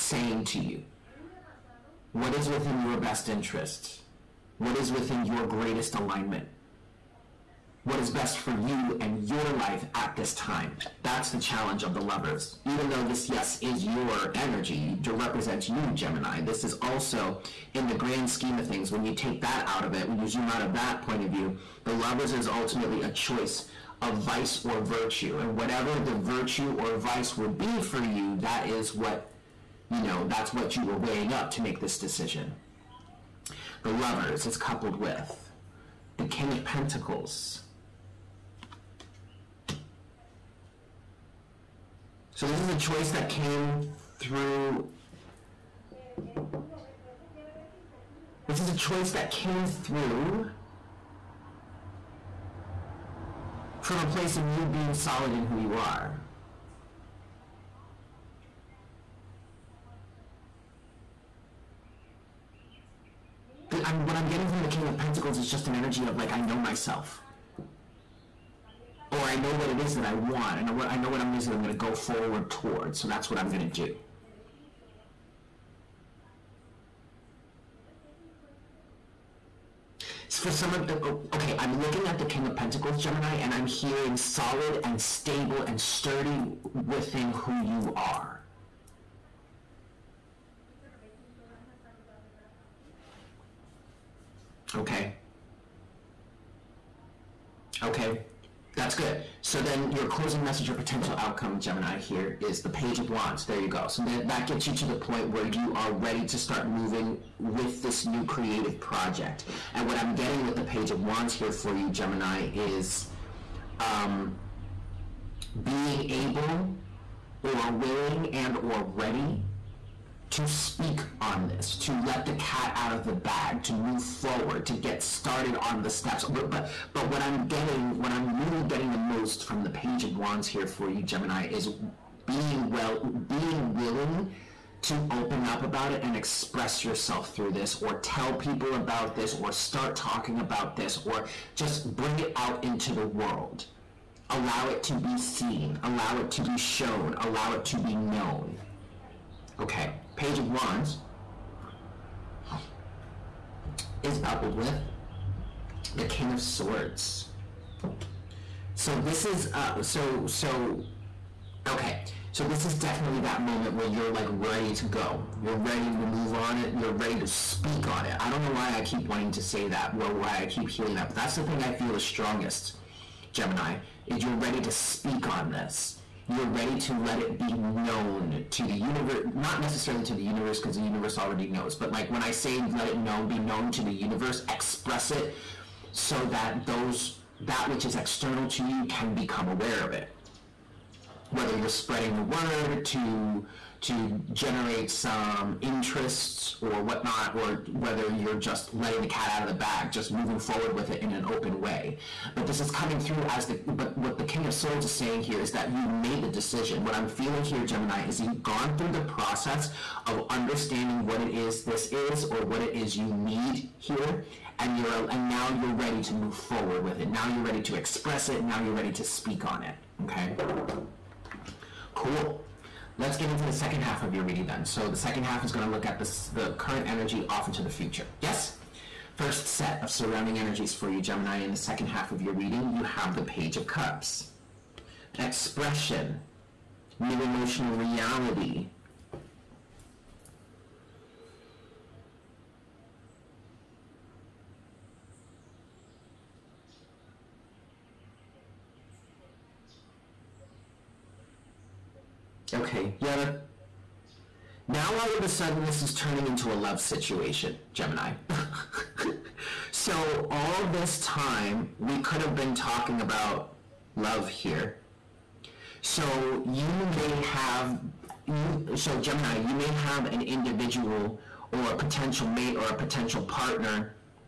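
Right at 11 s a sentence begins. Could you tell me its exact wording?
That's the challenge of the lovers.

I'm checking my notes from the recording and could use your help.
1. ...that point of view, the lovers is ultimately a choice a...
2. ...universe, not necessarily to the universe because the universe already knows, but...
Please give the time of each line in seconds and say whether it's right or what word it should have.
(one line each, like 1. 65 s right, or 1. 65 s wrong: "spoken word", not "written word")
1. 20 s right
2. 178 s right.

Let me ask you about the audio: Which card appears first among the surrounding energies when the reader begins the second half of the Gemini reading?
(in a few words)
Page of Cups.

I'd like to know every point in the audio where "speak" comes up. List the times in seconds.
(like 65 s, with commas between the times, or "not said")
120 s, 167 s, 174 s, 219 s.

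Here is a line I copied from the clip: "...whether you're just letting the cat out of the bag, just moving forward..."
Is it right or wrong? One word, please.
right.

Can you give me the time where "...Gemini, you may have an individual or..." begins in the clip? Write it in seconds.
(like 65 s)
268 s.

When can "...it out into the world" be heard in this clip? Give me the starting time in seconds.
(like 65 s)
142 s.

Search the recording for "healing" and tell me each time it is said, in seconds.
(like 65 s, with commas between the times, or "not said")
170 s.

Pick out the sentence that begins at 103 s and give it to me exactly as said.
So that, that gets you to the point where you are ready to start moving with this new creative project.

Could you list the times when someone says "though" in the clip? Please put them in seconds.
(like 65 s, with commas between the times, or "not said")
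12 s.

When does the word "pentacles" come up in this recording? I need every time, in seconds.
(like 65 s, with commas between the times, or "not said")
36 s, 64 s, 82 s.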